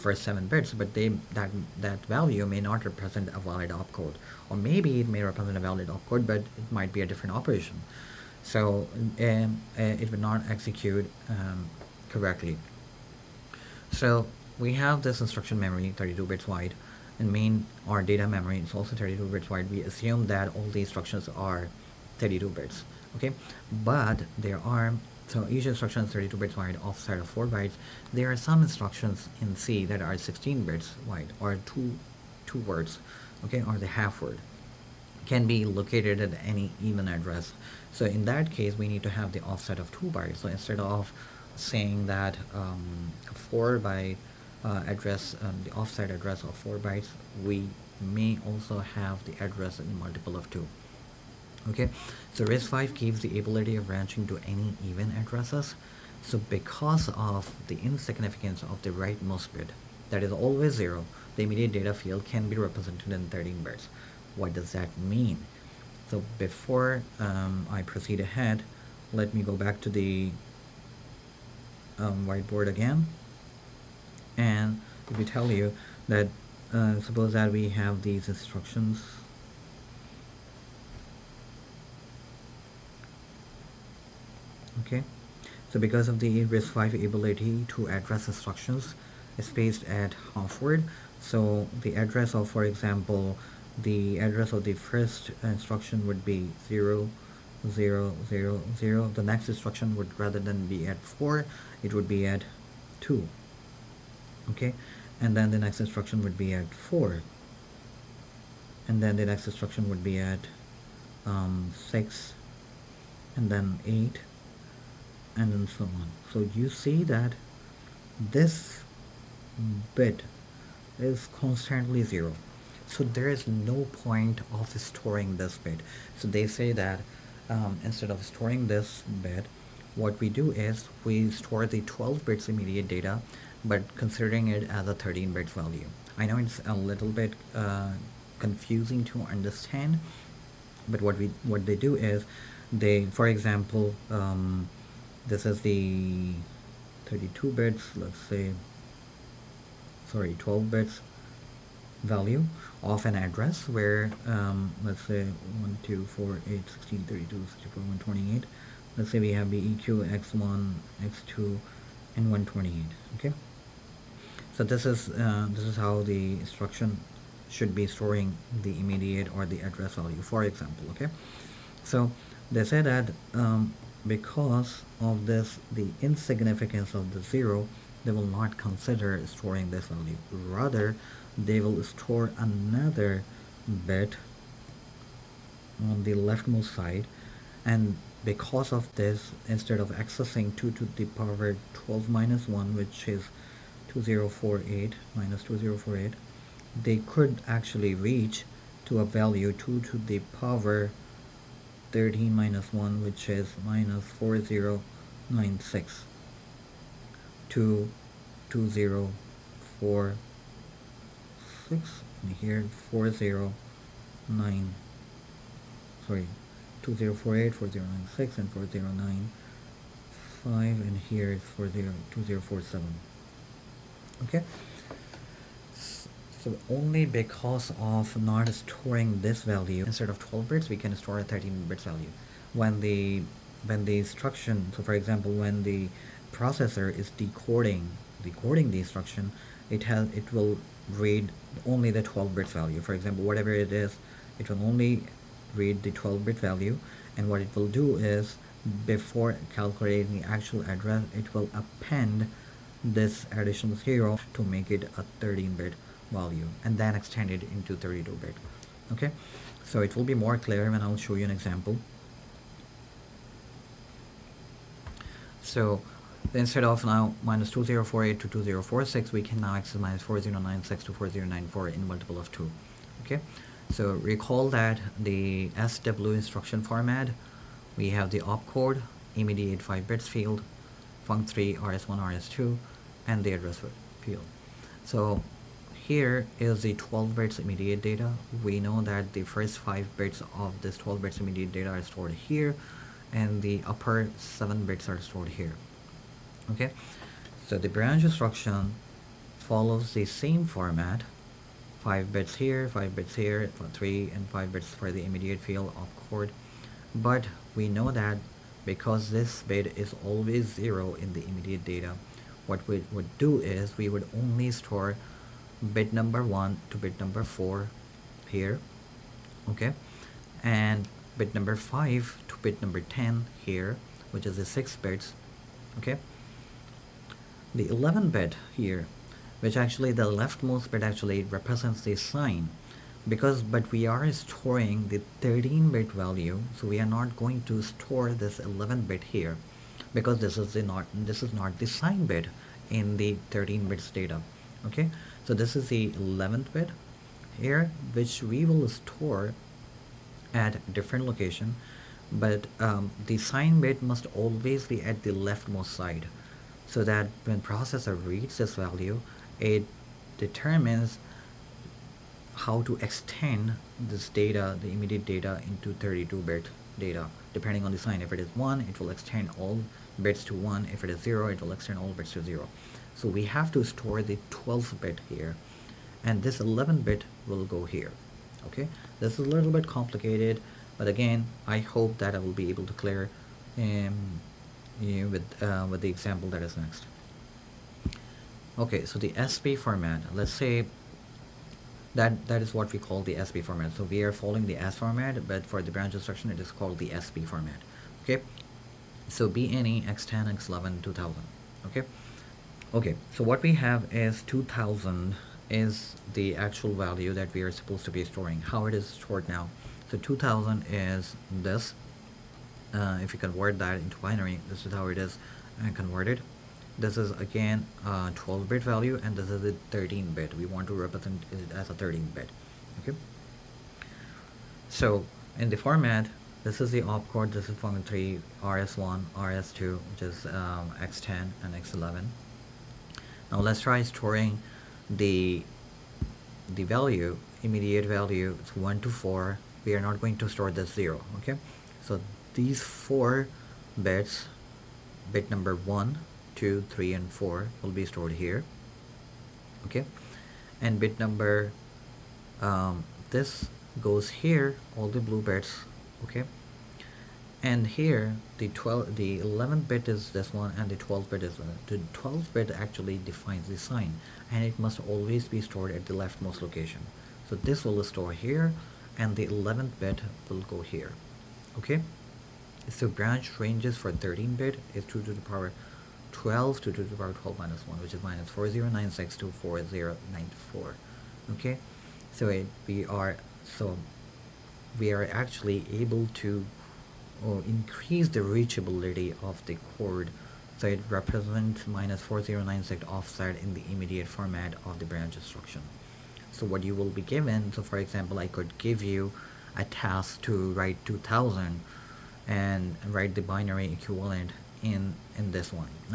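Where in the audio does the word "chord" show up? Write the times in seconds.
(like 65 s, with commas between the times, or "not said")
306 s, 489 s.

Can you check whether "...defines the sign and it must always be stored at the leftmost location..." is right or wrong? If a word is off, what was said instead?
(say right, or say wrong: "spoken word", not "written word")
right.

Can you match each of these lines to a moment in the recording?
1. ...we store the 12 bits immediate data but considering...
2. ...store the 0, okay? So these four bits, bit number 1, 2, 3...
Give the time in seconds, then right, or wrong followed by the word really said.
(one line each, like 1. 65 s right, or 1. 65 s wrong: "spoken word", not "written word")
1. 131 s right
2. 440 s right.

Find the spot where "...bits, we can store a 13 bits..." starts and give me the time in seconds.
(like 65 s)
230 s.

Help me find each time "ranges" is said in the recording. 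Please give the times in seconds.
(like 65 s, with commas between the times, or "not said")
473 s.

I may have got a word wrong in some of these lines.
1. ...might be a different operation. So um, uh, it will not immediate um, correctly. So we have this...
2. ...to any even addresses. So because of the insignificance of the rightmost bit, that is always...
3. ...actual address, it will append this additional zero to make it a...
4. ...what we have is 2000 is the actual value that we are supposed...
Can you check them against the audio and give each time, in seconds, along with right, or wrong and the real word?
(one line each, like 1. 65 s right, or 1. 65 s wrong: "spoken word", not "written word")
1. 6 s wrong: "execute", not "immediate"
2. 54 s right
3. 250 s right
4. 403 s right.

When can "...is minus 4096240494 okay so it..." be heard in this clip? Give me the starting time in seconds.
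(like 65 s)
477 s.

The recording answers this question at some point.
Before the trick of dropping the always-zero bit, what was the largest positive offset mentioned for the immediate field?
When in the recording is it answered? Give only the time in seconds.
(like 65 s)
268 s.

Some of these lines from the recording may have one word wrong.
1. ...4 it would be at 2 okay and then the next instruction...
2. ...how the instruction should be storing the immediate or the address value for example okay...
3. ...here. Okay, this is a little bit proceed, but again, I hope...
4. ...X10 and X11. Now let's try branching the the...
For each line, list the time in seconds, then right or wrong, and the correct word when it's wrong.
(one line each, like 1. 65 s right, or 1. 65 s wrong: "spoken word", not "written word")
1. 101 s right
2. 165 s right
3. 377 s wrong: "complicated", not "proceed"
4. 430 s wrong: "storing", not "branching".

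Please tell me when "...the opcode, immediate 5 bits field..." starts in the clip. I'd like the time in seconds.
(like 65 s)
278 s.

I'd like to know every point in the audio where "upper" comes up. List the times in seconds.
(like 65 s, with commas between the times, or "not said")
293 s.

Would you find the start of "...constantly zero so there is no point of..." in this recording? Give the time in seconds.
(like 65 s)
121 s.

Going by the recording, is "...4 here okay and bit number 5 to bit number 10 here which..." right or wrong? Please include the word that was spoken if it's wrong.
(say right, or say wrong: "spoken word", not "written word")
right.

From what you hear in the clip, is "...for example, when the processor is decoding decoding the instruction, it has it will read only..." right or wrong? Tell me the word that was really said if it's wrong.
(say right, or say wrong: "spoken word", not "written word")
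right.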